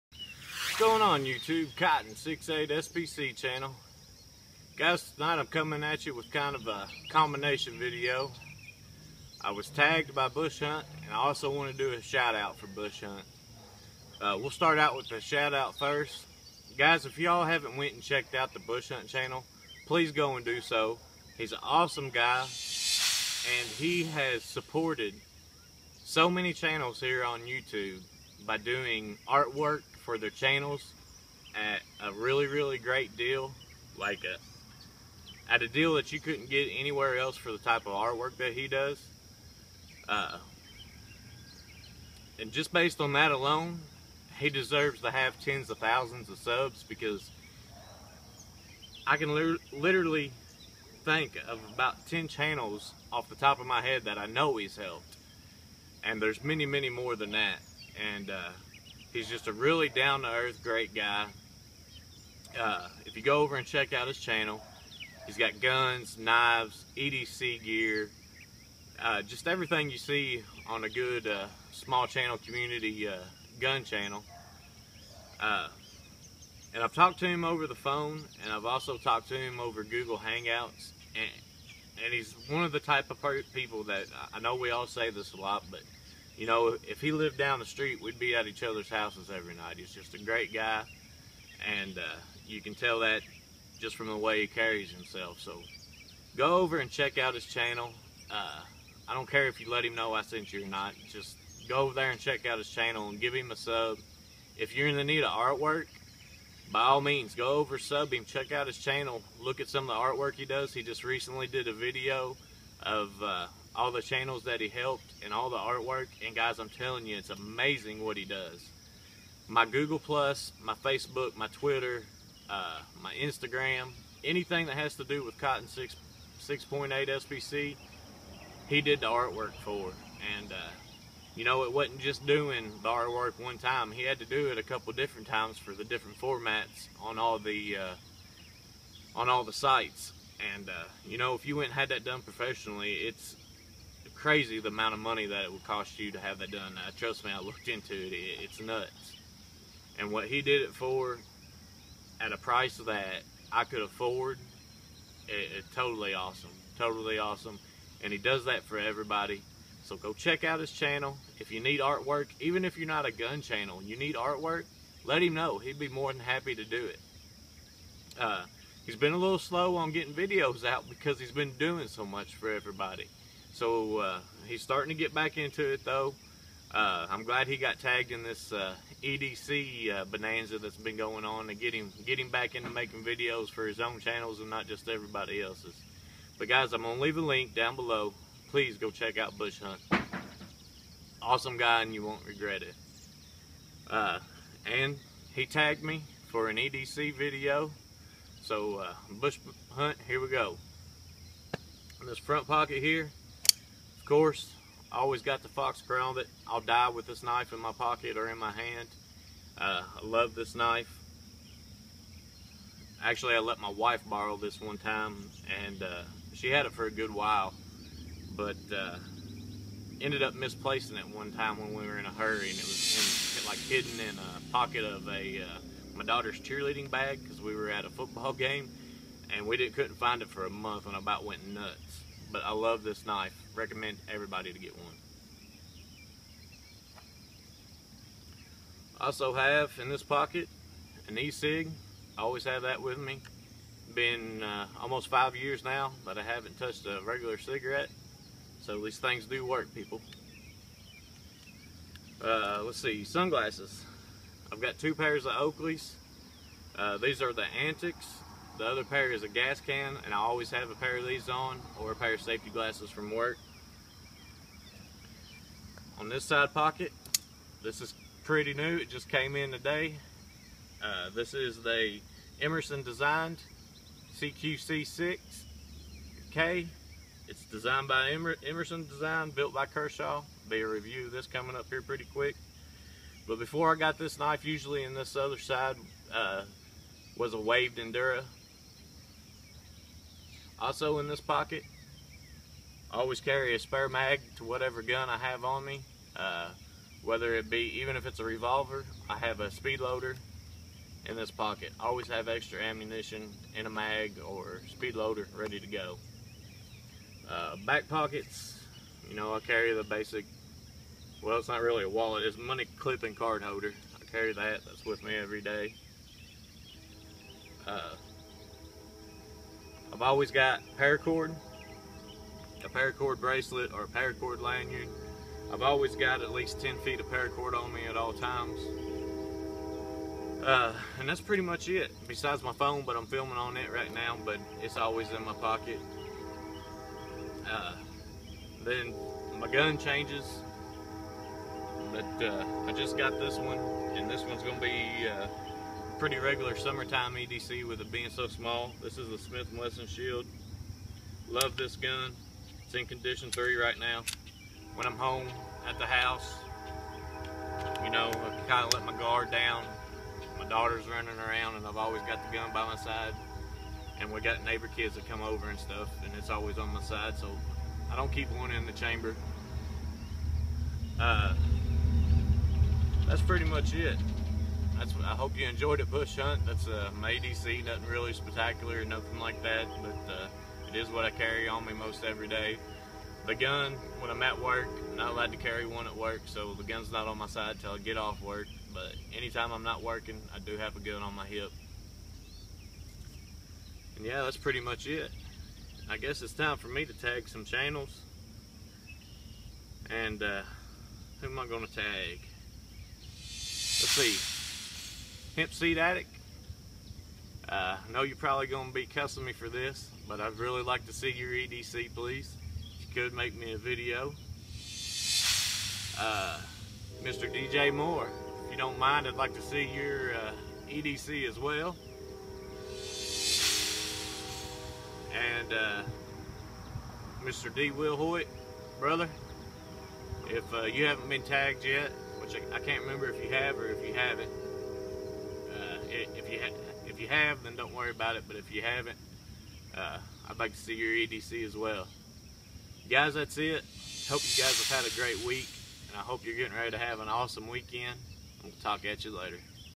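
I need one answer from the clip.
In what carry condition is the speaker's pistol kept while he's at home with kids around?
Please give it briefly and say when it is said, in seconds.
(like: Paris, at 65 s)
condition three, at 352 s.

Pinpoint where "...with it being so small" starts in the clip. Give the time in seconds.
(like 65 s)
347 s.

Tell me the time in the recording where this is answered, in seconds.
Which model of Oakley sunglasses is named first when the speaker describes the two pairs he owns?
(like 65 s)
257 s.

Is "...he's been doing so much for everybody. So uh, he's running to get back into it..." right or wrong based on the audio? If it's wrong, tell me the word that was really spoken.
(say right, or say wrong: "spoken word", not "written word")
wrong: "starting", not "running".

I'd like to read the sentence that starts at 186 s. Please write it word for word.
But guys, I'm gonna leave a link down below.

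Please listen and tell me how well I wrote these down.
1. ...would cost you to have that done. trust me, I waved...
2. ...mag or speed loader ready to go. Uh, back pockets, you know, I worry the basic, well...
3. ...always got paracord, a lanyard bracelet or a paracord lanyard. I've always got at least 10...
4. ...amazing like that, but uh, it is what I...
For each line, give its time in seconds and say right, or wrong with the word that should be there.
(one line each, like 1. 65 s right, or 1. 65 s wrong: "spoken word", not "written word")
1. 145 s wrong: "looked", not "waved"
2. 303 s wrong: "carry", not "worry"
3. 320 s wrong: "paracord", not "lanyard"
4. 378 s wrong: "nothing", not "amazing".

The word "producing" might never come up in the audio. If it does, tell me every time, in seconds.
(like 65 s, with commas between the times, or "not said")
not said.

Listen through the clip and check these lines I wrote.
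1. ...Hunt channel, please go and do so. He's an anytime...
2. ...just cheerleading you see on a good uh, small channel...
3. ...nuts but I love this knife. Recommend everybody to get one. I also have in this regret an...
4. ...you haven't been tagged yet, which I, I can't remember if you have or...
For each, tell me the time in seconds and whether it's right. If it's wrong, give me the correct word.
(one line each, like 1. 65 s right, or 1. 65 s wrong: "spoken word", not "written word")
1. 18 s wrong: "awesome", not "anytime"
2. 69 s wrong: "everything", not "cheerleading"
3. 231 s wrong: "pocket", not "regret"
4. 430 s right.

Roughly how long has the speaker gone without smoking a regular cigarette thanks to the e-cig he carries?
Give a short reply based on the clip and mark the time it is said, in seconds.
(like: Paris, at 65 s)
almost 5 years, at 244 s.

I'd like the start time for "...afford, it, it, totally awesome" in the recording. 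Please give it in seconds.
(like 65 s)
153 s.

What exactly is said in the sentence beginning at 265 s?
On this side pocket, this is pretty new.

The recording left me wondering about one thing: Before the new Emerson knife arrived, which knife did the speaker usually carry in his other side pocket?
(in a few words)
waved Endura.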